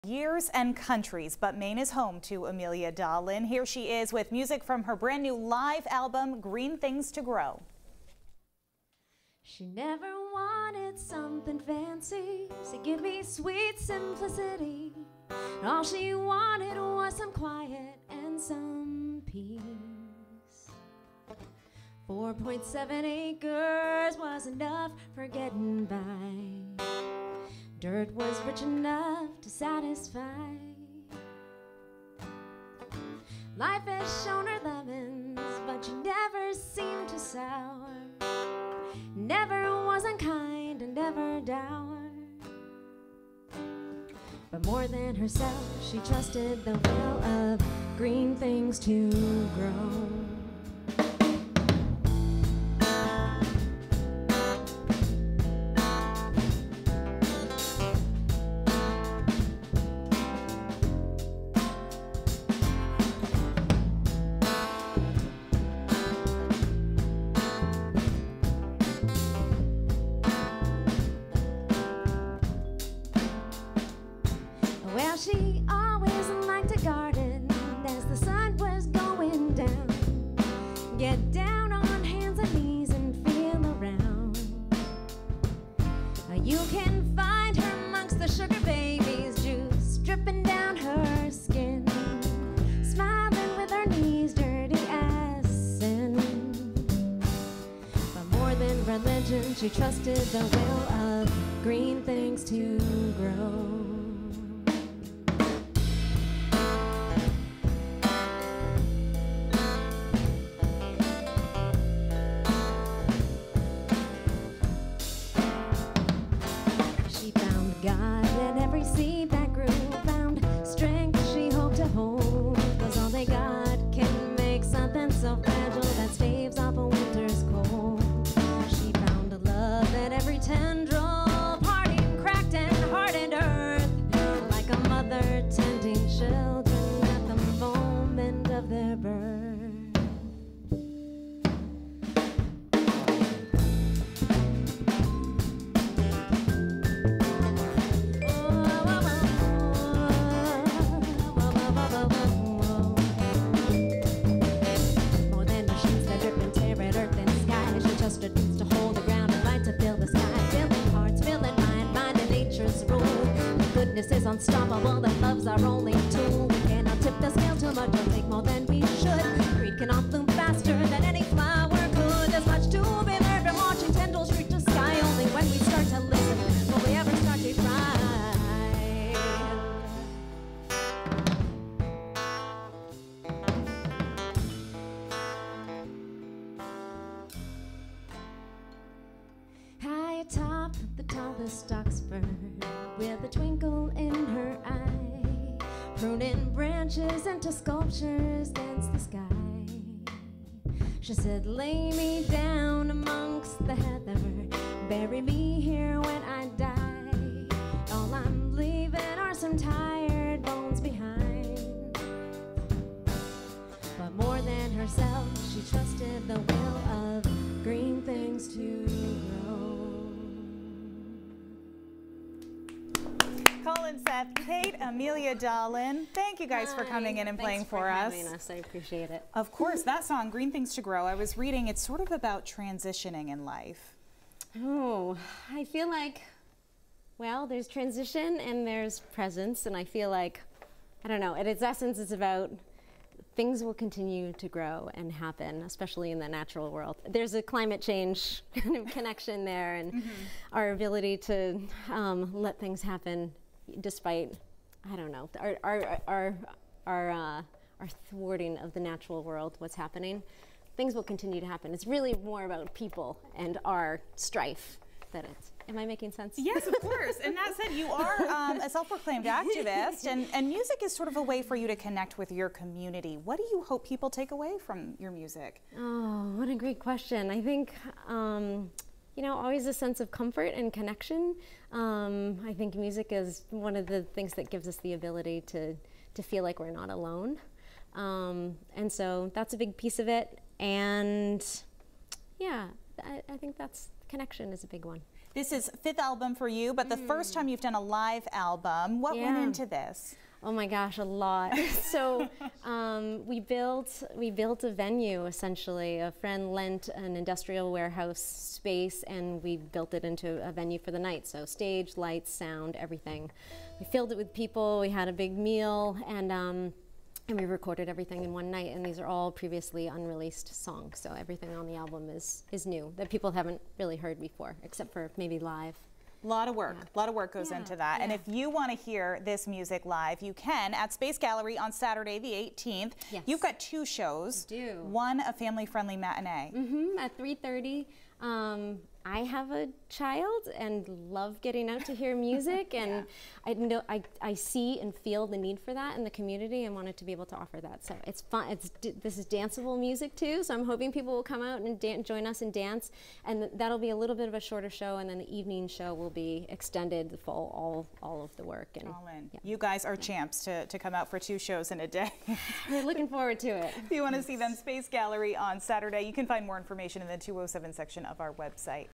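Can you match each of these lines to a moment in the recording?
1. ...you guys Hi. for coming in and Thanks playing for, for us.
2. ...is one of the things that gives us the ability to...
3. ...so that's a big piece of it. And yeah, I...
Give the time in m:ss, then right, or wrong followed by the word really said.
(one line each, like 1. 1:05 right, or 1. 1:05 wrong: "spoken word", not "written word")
1. 3:46 right
2. 4:43 right
3. 4:48 right.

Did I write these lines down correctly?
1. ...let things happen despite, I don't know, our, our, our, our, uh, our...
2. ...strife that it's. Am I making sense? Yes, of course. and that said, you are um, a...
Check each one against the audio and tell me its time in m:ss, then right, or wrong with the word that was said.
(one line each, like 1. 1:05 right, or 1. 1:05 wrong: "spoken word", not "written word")
1. 4:12 right
2. 4:24 right.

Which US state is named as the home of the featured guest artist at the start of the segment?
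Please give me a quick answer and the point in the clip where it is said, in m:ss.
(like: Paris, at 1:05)
Maine, at 0:01.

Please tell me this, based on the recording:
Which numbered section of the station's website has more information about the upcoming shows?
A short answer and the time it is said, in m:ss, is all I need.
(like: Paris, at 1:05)
207, at 6:07.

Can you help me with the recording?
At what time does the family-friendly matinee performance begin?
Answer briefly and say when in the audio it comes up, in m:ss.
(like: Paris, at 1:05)
3:30, at 5:37.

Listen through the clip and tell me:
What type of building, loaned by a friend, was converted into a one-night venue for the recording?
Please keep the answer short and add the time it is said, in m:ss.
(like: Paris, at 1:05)
industrial warehouse, at 5:07.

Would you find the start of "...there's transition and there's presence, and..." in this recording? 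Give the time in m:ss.
3:57.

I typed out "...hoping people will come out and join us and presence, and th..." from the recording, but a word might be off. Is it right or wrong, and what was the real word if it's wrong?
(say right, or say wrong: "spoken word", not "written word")
wrong: "dance", not "presence".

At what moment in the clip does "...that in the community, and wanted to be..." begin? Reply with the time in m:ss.
5:45.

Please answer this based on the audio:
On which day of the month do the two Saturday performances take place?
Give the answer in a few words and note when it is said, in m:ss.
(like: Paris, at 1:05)
18th, at 5:32.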